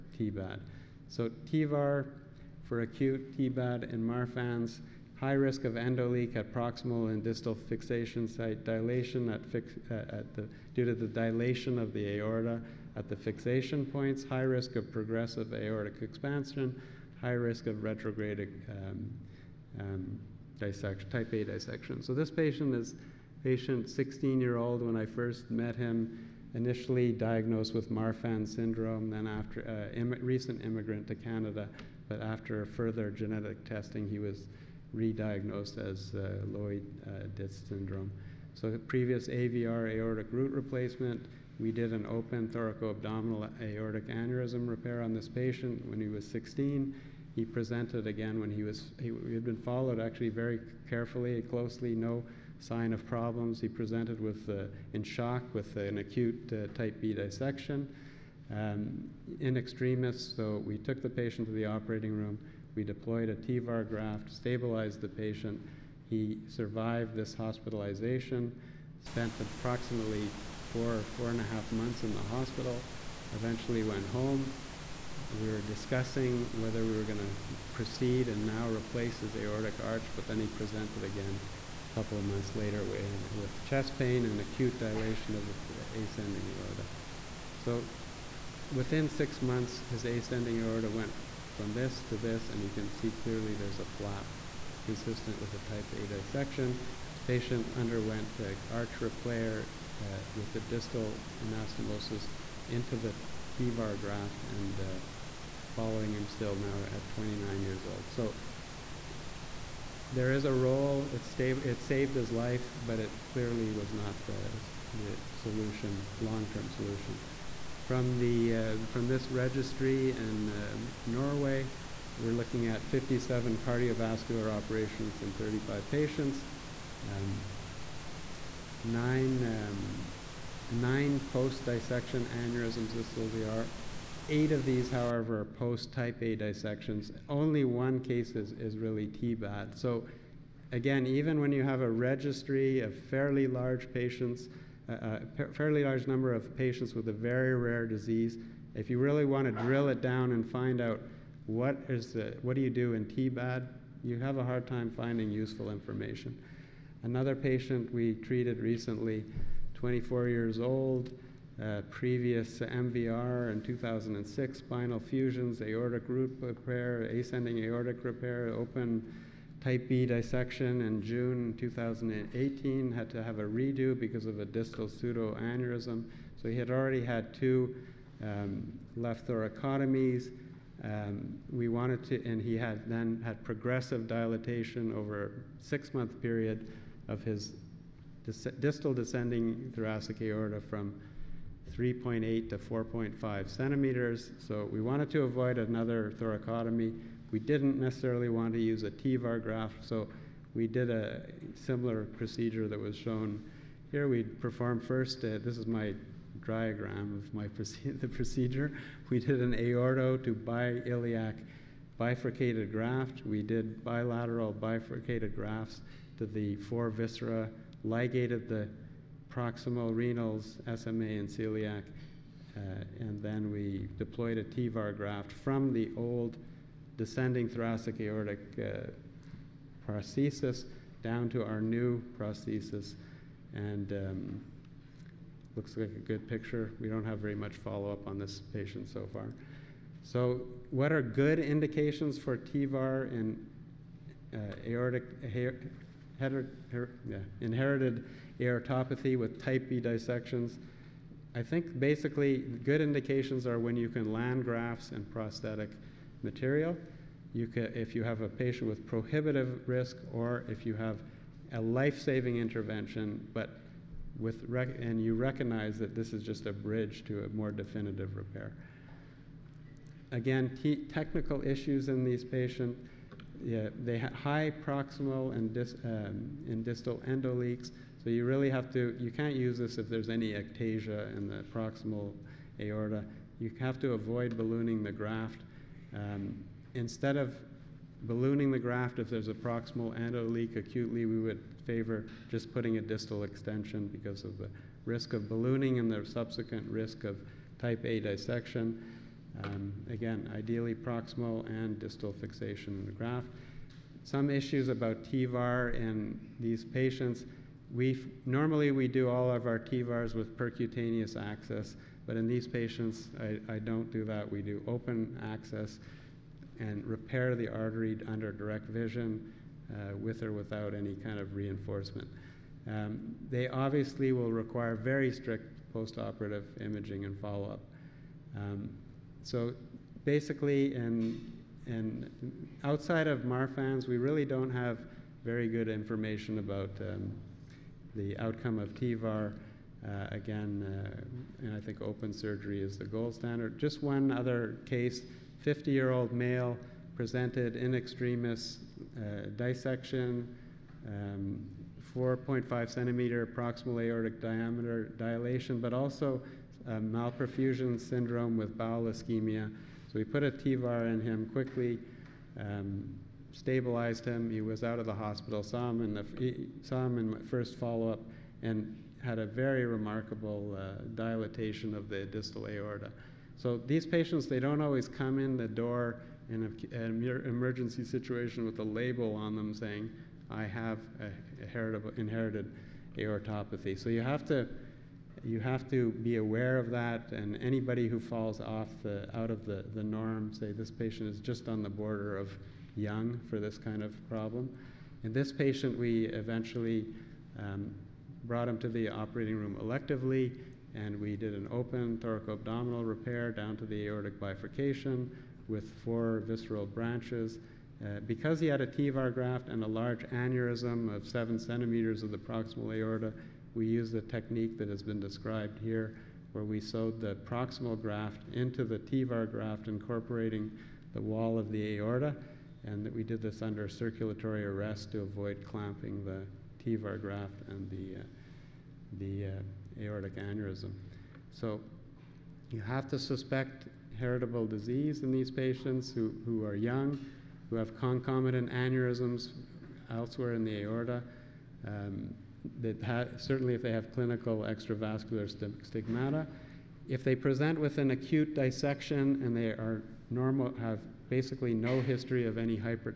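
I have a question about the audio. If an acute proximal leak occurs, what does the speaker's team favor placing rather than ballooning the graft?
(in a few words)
distal extension.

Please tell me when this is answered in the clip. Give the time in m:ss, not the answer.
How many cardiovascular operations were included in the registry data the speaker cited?
2:02.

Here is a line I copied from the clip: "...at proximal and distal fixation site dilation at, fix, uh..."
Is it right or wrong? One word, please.
right.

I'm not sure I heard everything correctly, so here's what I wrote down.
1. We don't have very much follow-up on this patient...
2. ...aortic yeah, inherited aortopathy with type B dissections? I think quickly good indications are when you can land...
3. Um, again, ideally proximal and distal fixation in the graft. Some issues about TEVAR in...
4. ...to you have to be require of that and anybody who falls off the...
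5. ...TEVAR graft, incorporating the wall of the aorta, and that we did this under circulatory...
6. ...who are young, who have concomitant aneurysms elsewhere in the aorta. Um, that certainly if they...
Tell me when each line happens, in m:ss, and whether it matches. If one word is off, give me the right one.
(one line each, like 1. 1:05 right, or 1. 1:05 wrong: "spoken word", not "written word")
1. 3:56 right
2. 4:04 wrong: "basically", not "quickly"
3. 4:59 right
4. 6:24 wrong: "aware", not "require"
5. 6:58 right
6. 7:16 right.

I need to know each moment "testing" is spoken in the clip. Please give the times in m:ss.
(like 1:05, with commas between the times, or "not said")
0:33.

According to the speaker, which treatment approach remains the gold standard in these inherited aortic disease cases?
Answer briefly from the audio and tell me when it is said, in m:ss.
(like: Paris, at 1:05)
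open surgery, at 5:41.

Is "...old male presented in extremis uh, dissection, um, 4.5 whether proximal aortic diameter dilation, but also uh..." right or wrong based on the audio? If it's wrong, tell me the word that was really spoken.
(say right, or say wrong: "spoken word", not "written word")
wrong: "centimeter", not "whether".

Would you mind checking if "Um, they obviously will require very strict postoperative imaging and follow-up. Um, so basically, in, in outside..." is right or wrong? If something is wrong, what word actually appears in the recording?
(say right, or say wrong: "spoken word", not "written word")
right.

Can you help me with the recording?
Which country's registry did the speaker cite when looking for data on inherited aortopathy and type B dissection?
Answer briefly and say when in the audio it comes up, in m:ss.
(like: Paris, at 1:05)
Norway, at 2:01.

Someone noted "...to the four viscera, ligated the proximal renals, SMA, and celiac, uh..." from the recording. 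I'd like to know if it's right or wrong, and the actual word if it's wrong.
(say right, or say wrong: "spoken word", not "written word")
right.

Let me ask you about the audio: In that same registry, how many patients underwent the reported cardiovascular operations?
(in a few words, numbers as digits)
35.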